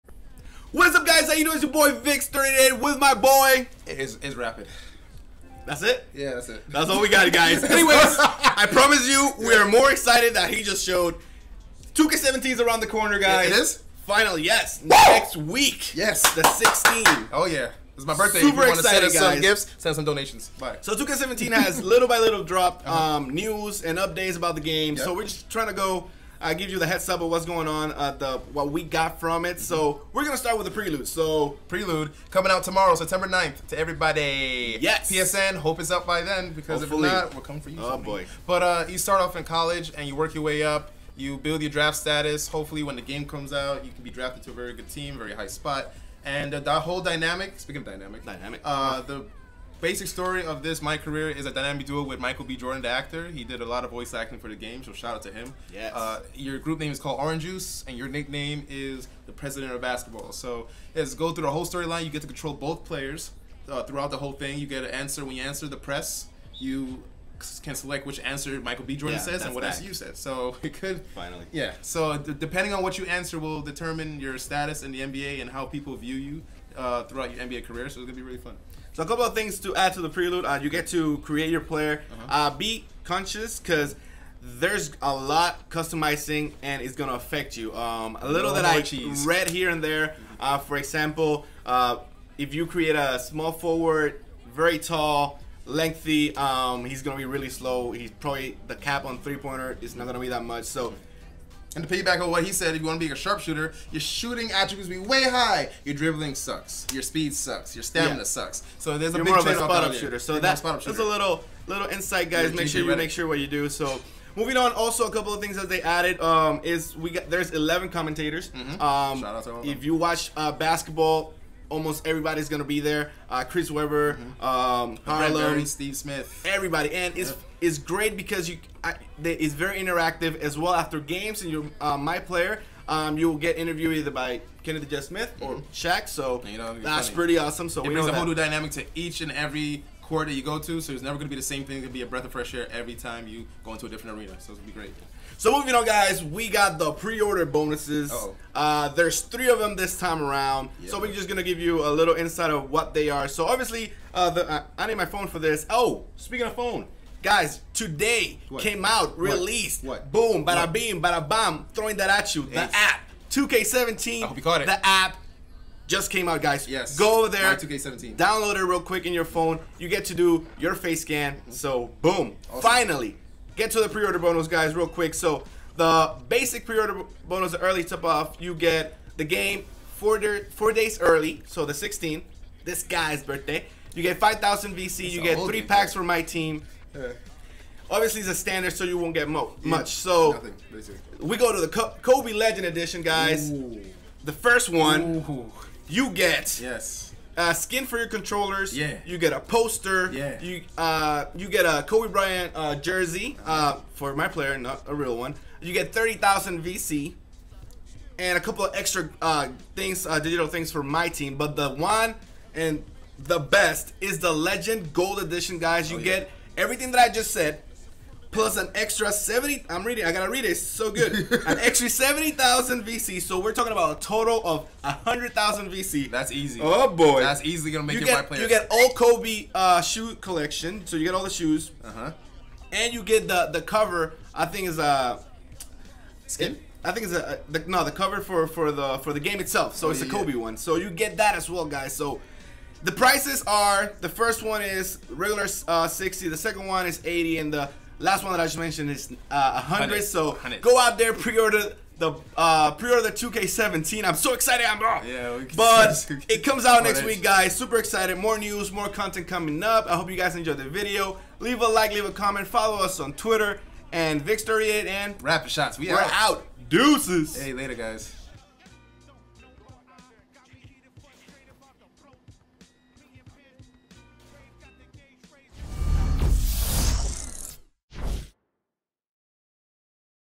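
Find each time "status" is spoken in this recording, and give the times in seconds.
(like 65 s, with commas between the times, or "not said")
41 s, 74 s.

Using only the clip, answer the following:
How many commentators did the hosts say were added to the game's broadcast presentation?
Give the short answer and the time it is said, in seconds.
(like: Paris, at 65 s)
11, at 117 s.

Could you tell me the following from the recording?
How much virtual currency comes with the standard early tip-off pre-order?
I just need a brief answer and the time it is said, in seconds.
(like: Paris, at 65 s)
5,000 VC, at 184 s.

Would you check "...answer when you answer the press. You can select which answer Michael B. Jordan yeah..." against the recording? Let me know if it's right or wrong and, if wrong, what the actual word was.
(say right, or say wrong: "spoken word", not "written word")
right.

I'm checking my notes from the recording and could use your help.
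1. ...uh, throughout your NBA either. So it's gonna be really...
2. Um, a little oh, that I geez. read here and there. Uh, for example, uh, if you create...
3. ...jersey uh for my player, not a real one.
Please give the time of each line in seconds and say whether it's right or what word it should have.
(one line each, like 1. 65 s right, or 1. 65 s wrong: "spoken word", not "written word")
1. 76 s wrong: "career", not "either"
2. 87 s right
3. 202 s right.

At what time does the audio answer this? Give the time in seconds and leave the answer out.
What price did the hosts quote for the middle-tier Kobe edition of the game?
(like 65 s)
247 s.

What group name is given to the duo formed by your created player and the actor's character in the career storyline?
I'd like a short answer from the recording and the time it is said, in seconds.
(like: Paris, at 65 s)
Orange Juice, at 57 s.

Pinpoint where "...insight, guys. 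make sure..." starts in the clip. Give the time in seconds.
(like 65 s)
111 s.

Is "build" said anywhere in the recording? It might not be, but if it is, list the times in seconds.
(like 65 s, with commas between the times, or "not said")
41 s.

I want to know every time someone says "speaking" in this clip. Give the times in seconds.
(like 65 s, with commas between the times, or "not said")
47 s, 156 s.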